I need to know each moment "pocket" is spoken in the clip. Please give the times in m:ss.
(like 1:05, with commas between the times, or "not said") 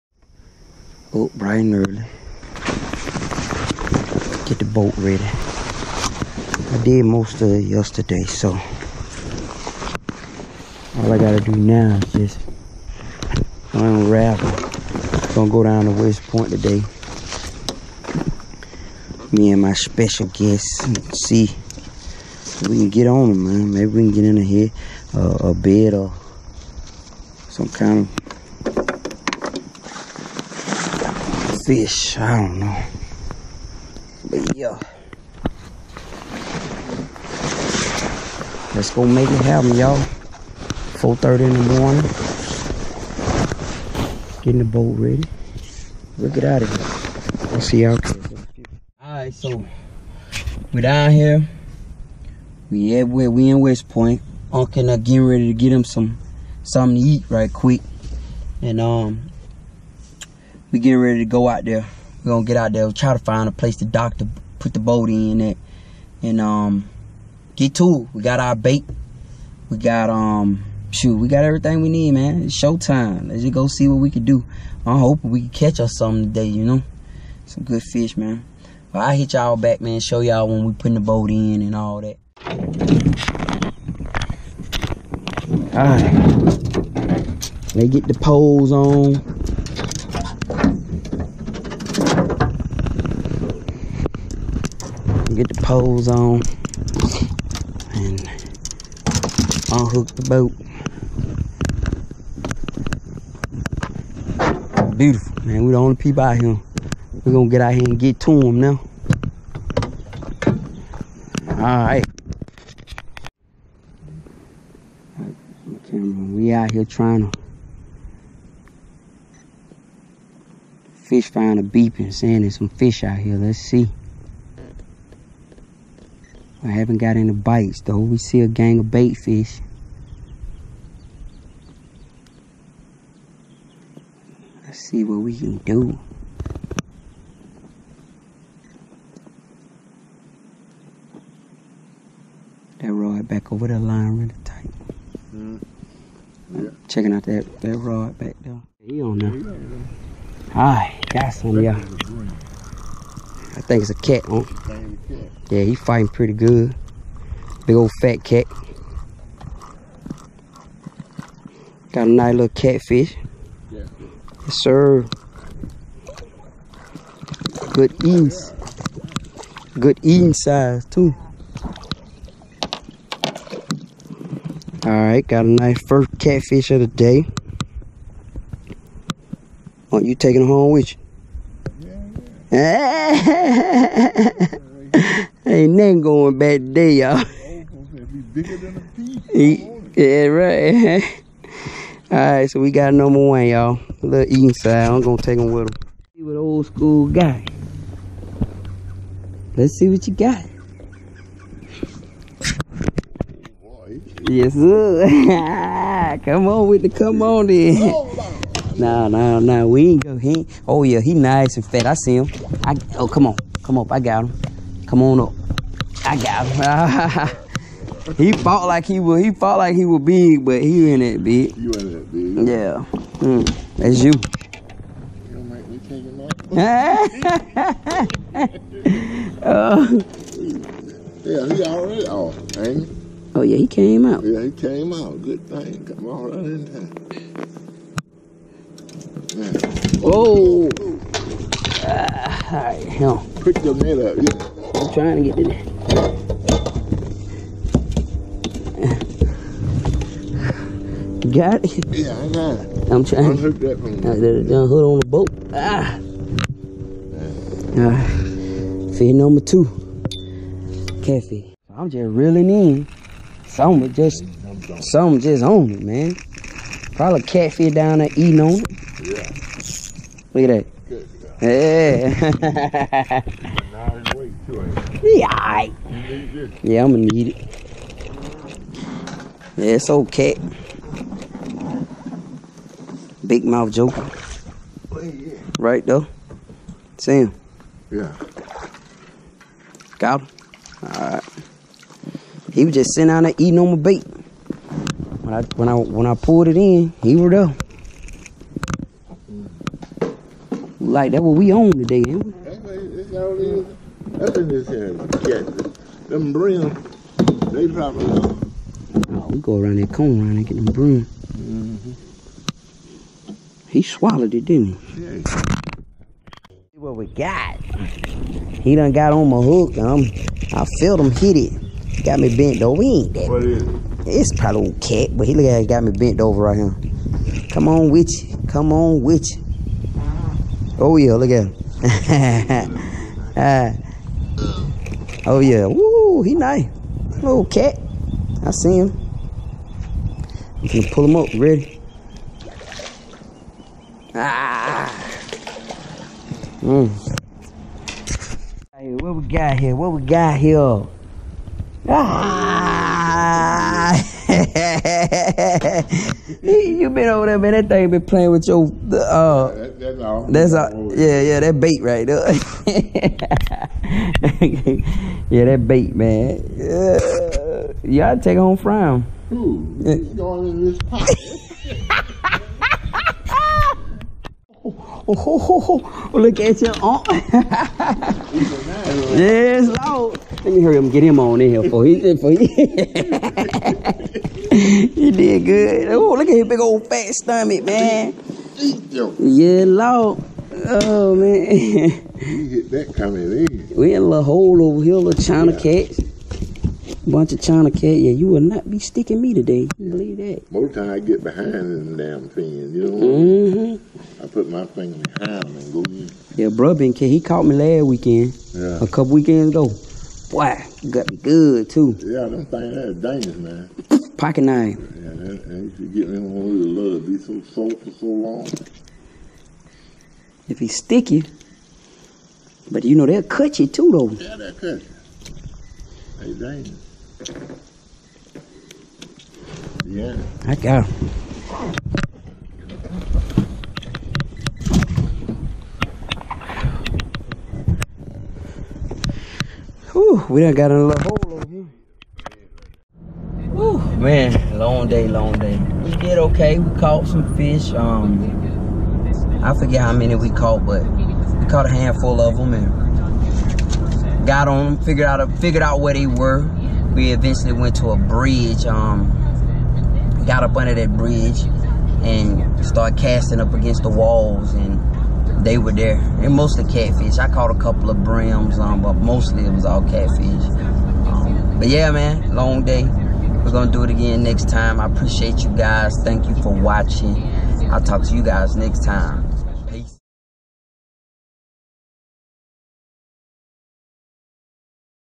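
6:10, 6:54.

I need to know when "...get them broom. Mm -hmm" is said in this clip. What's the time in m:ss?
5:10.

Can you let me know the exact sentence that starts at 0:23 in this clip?
Maybe we can get in here, uh, a bed or some kind of fish.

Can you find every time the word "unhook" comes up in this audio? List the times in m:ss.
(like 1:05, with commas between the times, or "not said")
1:39, 4:13.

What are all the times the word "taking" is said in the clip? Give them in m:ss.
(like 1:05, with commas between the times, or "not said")
3:00.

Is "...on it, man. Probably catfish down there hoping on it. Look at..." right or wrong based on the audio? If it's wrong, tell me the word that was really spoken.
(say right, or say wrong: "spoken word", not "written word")
wrong: "eating", not "hoping".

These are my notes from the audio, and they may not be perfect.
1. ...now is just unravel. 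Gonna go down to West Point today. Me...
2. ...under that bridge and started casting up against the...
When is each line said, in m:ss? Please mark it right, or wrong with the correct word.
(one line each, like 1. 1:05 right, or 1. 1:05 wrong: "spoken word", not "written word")
1. 0:11 right
2. 7:40 right.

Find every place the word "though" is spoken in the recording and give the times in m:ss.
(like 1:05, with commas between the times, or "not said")
2:07, 4:45, 7:03.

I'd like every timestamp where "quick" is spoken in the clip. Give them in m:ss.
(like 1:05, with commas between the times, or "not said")
0:57.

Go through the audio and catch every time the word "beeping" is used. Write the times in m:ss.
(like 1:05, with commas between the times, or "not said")
2:01.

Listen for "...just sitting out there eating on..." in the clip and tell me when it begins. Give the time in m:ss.
4:52.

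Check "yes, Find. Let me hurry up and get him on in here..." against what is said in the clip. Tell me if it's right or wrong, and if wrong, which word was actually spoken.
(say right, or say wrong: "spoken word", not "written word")
wrong: "Lord", not "Find".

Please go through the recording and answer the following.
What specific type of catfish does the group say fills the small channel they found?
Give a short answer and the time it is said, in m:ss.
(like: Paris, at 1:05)
channel cat, at 6:37.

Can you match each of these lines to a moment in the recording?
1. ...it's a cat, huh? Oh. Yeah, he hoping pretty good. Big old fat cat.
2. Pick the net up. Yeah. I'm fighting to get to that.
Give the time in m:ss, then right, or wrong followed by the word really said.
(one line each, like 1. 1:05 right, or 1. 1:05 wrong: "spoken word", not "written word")
1. 2:33 wrong: "fighting", not "hoping"
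2. 4:03 wrong: "trying", not "fighting".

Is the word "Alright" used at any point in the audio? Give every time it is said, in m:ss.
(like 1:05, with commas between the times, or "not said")
0:49, 1:51, 2:30, 2:54, 4:50.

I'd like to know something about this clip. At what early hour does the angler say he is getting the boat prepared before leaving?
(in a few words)
4:30 in the morning.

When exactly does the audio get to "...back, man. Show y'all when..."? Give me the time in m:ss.
1:19.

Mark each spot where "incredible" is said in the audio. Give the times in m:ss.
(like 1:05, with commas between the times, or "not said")
not said.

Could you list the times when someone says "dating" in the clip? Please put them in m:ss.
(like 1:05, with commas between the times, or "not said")
not said.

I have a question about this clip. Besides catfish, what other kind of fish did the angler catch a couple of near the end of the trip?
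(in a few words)
brim.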